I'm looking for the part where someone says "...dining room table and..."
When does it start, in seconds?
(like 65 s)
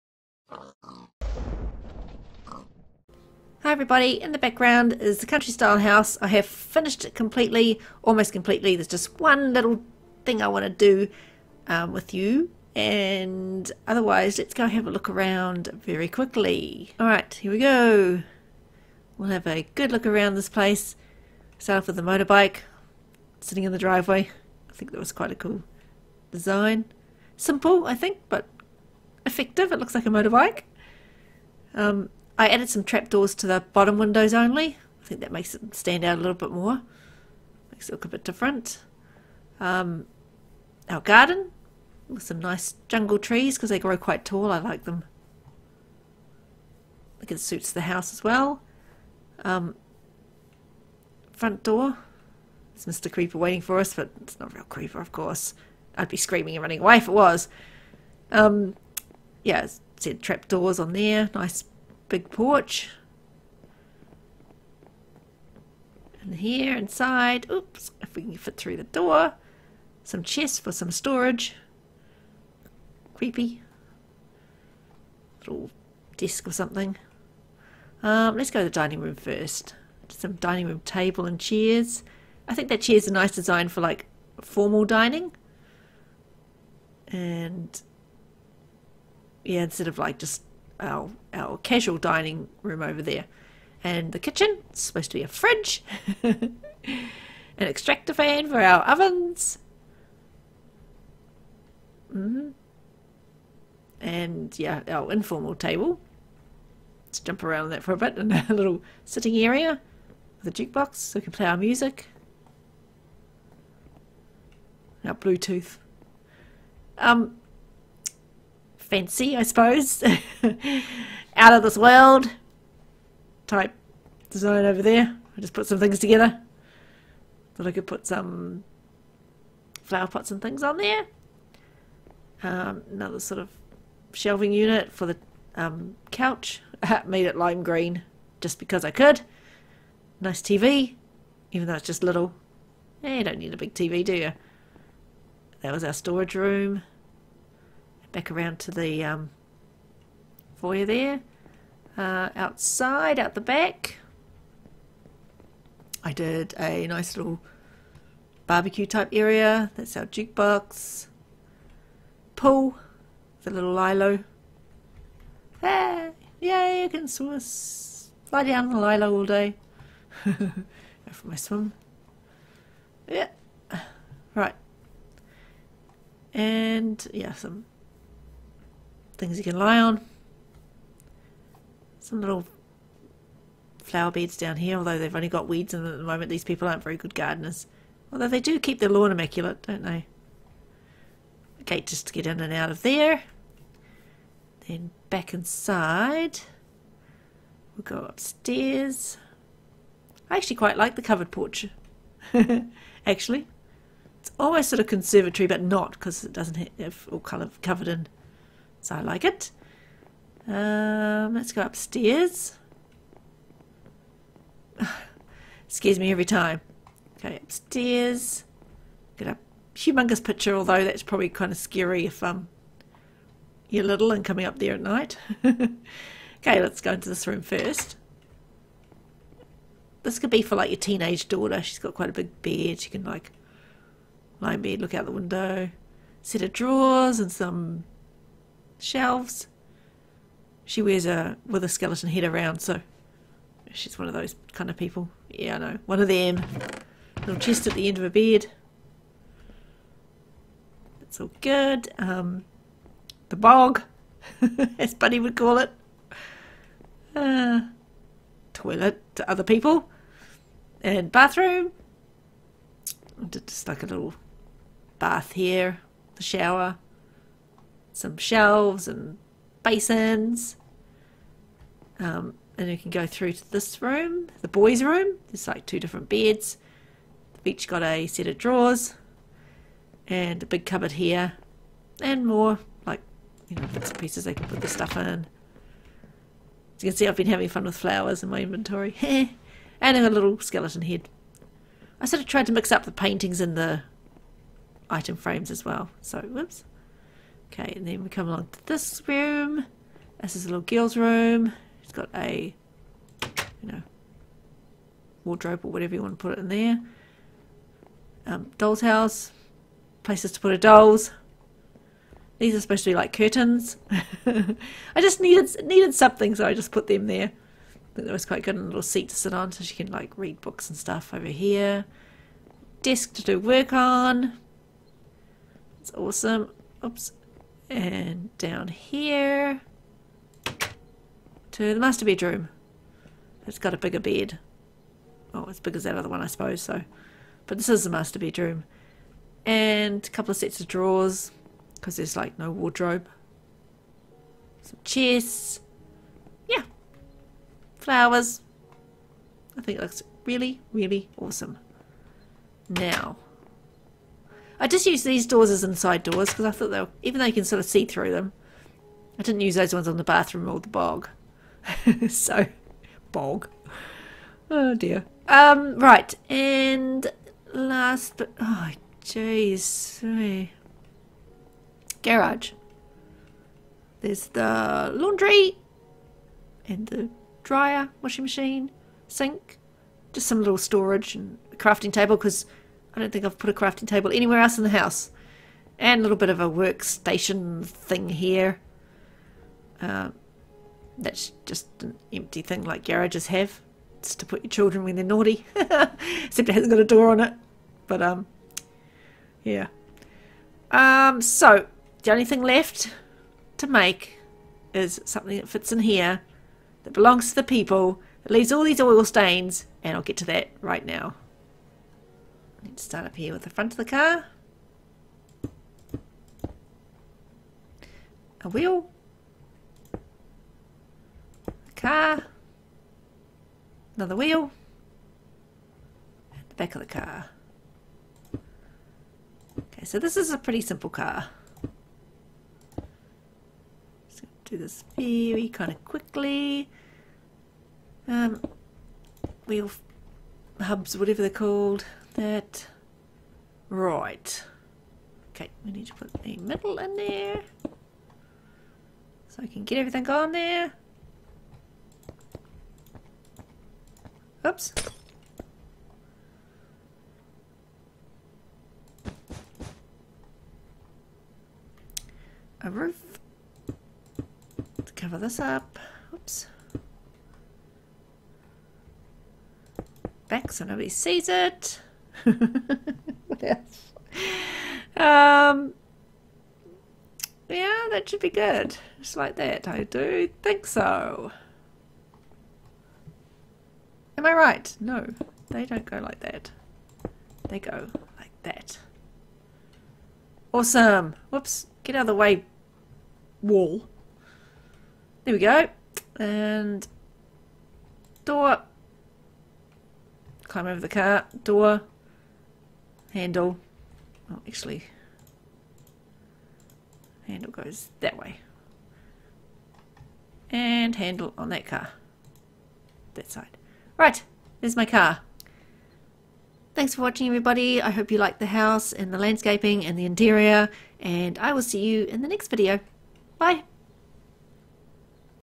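80 s.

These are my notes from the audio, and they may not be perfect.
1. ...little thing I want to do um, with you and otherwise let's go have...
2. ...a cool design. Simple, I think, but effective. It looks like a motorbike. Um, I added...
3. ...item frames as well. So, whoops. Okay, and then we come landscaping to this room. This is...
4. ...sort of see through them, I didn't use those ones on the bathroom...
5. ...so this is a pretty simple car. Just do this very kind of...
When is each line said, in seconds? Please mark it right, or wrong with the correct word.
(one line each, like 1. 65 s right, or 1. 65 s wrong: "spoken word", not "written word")
1. 9 s right
2. 25 s right
3. 294 s wrong: "along", not "landscaping"
4. 357 s right
5. 429 s right.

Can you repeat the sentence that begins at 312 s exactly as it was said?
These are supposed to be like curtains.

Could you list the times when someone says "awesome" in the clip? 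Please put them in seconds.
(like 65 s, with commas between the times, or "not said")
325 s, 351 s, 490 s.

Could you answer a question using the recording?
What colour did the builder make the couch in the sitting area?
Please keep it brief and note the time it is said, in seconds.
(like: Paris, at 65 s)
Lime green, at 137 s.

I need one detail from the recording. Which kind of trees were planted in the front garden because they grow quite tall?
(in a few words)
Jungle trees.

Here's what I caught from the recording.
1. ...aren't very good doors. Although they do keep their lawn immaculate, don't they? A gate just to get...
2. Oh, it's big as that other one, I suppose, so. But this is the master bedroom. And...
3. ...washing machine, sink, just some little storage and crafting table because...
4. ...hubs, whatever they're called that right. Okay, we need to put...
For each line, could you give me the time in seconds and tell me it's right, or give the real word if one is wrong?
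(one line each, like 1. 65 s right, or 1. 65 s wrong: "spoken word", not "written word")
1. 186 s wrong: "gardeners", not "doors"
2. 335 s right
3. 378 s right
4. 440 s right.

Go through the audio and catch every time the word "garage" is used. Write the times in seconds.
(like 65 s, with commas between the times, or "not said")
372 s, 392 s.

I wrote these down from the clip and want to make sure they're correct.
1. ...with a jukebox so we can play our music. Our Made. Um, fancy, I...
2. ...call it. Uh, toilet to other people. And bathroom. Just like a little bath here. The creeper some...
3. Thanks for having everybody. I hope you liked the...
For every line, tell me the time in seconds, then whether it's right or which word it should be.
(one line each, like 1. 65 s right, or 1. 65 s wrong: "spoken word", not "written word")
1. 110 s wrong: "Bluetooth", not "Made"
2. 255 s wrong: "shower", not "creeper"
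3. 516 s wrong: "watching", not "having".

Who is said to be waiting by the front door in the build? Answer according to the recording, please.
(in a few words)
Mr. Creeper.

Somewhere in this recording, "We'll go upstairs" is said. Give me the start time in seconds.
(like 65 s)
197 s.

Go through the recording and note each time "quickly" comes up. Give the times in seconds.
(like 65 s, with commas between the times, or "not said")
16 s, 435 s.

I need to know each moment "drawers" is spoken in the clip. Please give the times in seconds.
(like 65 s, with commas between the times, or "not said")
236 s, 278 s, 340 s.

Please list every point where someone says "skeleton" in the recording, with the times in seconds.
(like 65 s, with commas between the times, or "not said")
241 s, 290 s.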